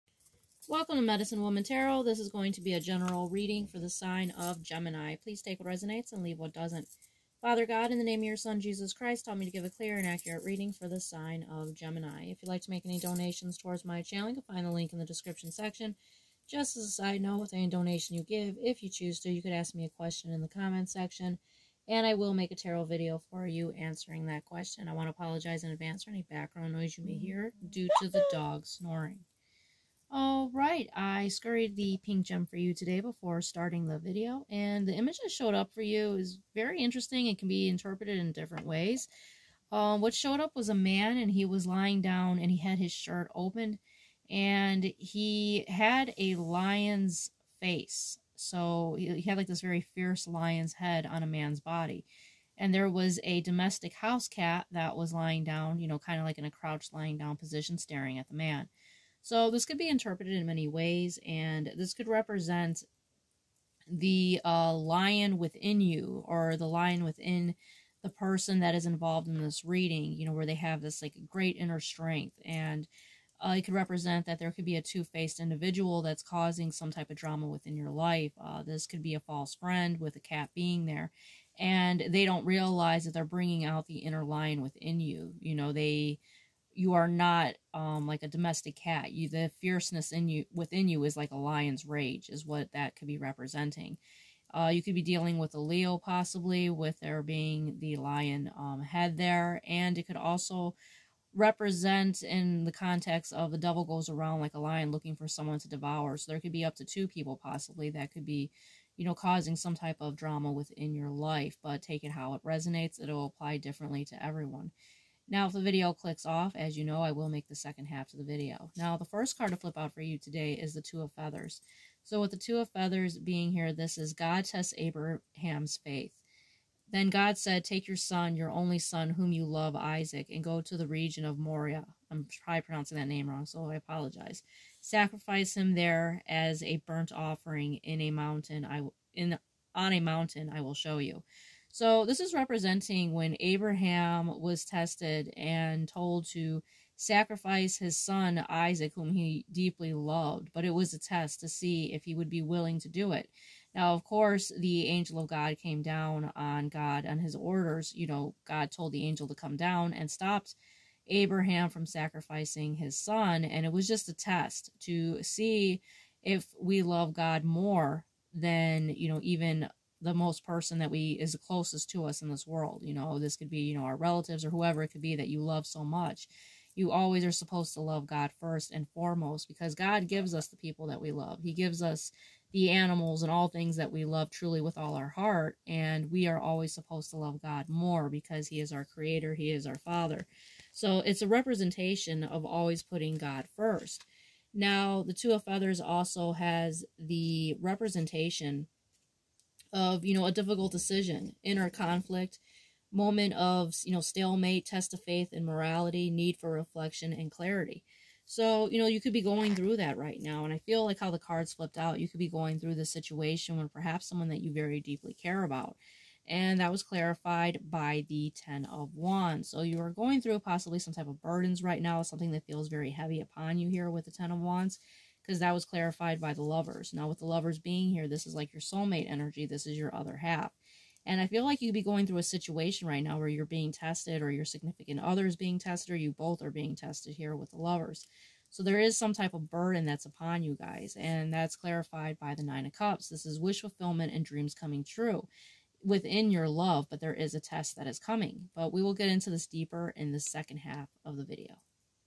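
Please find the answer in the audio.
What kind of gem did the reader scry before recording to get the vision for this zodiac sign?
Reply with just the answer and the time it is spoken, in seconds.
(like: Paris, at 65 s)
pink gem, at 32 s.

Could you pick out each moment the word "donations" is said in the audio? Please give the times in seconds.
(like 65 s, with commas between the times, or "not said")
12 s, 17 s.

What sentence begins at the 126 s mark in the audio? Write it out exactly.
Then God said, Take your son, your only son, whom you love, Isaac, and go to the region of Moriah.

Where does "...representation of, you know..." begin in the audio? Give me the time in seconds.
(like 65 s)
197 s.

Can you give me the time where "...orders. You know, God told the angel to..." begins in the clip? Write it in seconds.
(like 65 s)
157 s.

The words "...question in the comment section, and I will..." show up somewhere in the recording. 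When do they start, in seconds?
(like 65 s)
19 s.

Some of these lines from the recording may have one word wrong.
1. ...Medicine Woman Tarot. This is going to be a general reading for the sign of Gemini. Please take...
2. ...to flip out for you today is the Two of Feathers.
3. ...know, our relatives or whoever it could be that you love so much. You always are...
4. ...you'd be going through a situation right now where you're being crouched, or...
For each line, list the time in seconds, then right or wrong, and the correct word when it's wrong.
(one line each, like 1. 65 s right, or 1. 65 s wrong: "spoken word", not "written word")
1. 1 s right
2. 119 s right
3. 173 s right
4. 231 s wrong: "tested", not "crouched".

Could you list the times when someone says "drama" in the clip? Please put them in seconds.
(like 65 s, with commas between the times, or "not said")
77 s, 110 s.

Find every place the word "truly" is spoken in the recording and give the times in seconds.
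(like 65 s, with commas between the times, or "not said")
184 s.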